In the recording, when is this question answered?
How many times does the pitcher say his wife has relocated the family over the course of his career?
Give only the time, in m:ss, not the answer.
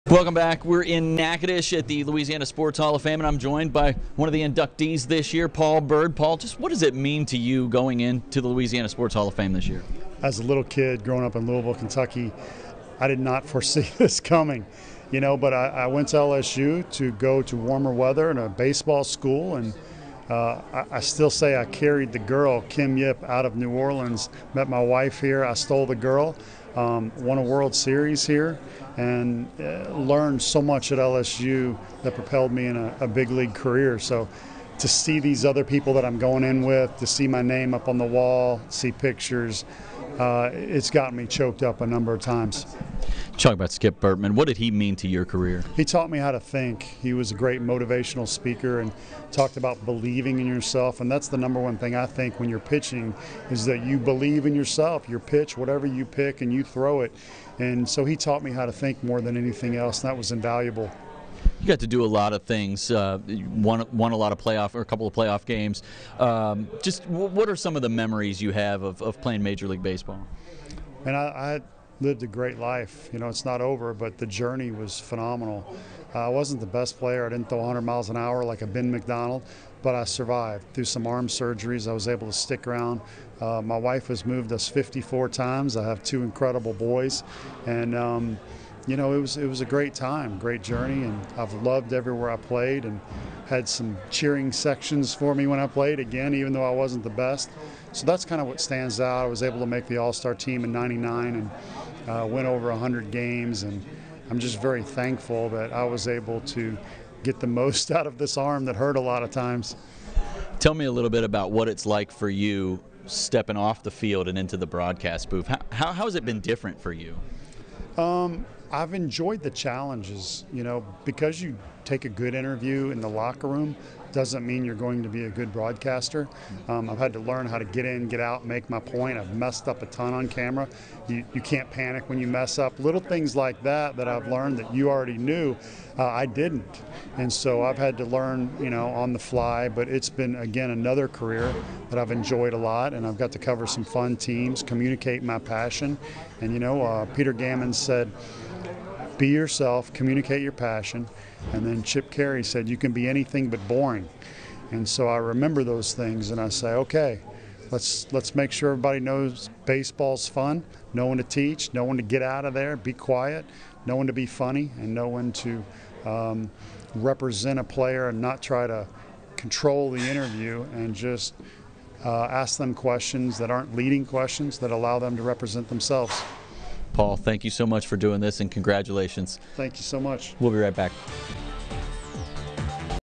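1:24.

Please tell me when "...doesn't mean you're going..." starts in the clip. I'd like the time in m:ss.
2:04.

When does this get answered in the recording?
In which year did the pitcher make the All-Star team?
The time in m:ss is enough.
1:40.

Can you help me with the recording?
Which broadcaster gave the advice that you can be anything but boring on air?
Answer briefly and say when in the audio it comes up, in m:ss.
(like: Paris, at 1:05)
Chip Caray, at 2:31.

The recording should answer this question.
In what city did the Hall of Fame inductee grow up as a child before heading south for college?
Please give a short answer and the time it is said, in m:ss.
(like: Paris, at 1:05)
Louisville, Kentucky, at 0:11.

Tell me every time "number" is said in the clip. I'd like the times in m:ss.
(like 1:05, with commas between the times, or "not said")
0:41, 0:51.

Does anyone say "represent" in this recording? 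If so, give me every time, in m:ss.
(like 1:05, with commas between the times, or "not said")
2:46, 2:55.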